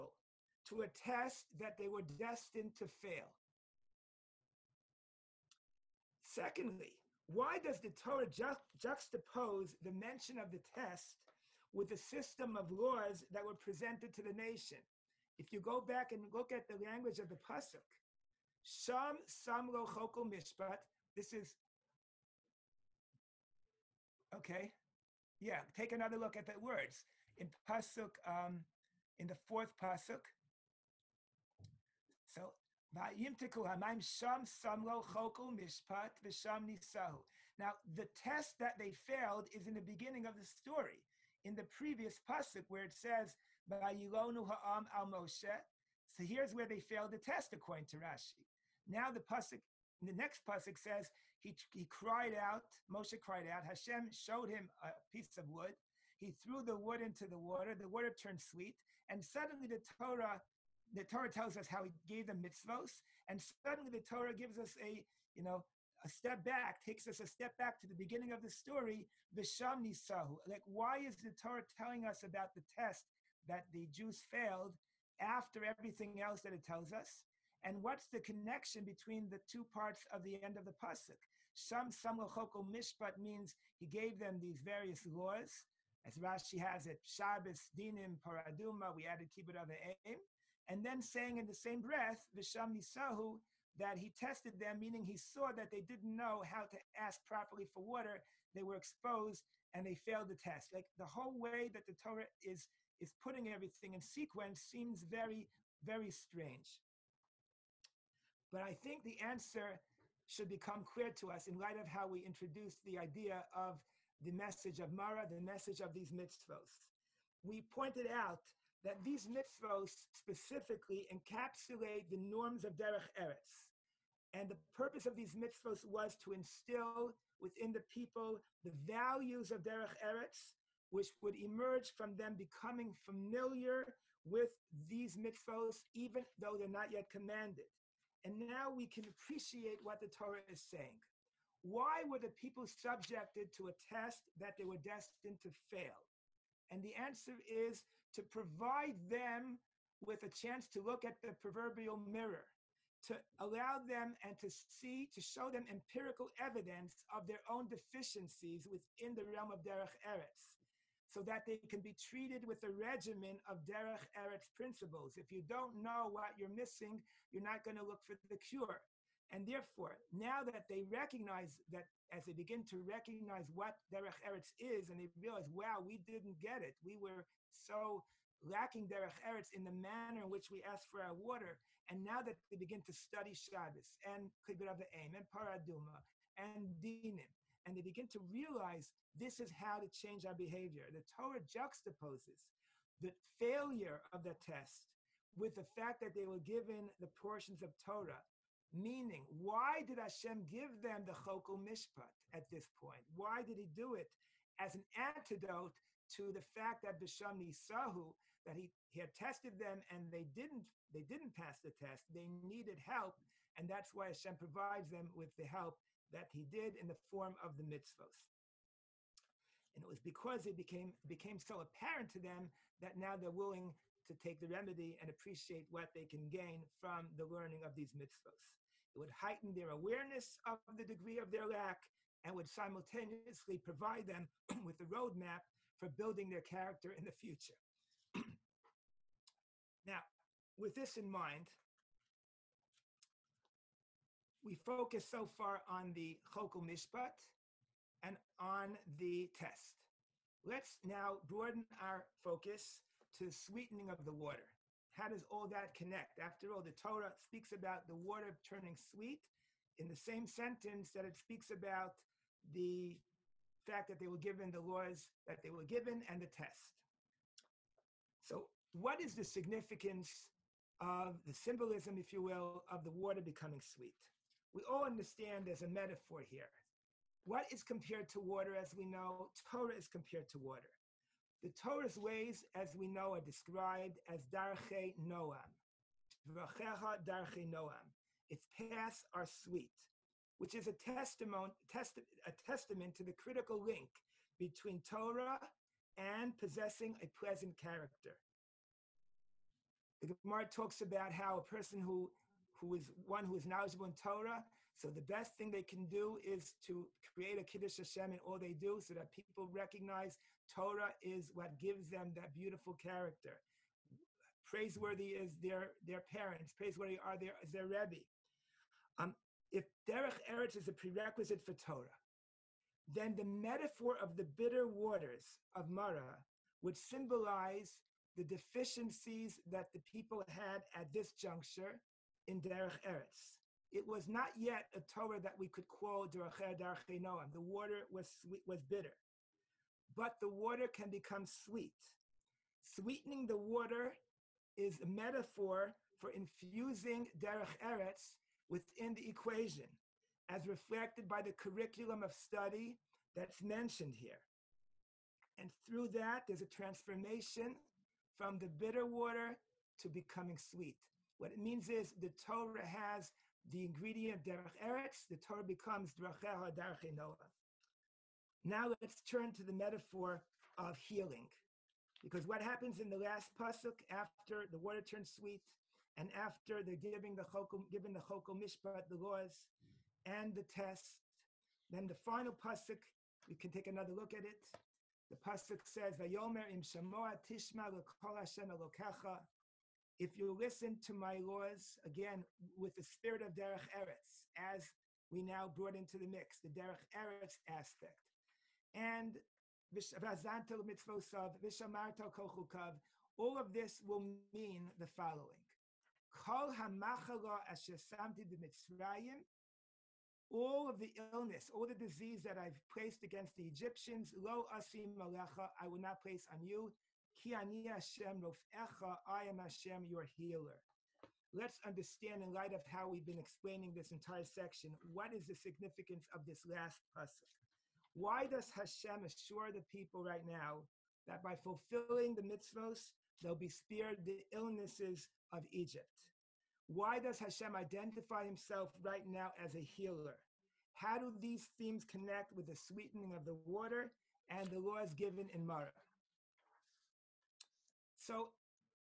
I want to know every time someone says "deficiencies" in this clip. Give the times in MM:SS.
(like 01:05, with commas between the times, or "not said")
02:37, 05:28.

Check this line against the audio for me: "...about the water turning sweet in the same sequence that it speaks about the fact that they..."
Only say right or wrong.
wrong.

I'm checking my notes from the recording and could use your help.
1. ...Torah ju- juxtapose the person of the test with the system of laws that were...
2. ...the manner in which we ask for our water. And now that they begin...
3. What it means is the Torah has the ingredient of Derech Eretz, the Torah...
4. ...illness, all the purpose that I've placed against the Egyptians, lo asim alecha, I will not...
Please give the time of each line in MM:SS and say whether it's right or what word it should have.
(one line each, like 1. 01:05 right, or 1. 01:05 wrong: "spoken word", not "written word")
1. 00:07 wrong: "mention", not "person"
2. 02:59 right
3. 06:01 right
4. 06:50 wrong: "disease", not "purpose".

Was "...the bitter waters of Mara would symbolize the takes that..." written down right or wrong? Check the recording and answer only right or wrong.
wrong.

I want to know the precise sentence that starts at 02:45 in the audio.
If you don't know what you're missing, you're not going to look for the cure.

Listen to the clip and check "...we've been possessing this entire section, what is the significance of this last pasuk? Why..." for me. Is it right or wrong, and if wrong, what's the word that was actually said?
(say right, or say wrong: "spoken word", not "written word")
wrong: "explaining", not "possessing".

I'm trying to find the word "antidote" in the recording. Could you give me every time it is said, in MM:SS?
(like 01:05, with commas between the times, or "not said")
03:24.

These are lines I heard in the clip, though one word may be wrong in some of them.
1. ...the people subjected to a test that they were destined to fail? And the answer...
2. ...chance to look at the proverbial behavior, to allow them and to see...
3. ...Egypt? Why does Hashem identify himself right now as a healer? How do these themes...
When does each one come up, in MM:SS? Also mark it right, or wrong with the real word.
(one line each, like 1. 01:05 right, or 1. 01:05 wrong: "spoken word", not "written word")
1. 02:22 right
2. 02:30 wrong: "mirror", not "behavior"
3. 07:15 right.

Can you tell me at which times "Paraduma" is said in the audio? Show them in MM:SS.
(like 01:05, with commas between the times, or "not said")
01:28, 03:05.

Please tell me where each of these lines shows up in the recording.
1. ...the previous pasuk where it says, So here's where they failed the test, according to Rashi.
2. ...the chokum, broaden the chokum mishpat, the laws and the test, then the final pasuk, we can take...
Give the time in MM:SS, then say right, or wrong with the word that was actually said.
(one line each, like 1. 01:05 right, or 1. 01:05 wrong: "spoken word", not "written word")
1. 00:41 right
2. 06:17 wrong: "given", not "broaden".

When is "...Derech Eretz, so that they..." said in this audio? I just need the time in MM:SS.
02:39.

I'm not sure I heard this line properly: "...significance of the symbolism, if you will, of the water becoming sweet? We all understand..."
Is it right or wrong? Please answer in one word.
right.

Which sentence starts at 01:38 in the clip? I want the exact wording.
They were exposed and they failed the test.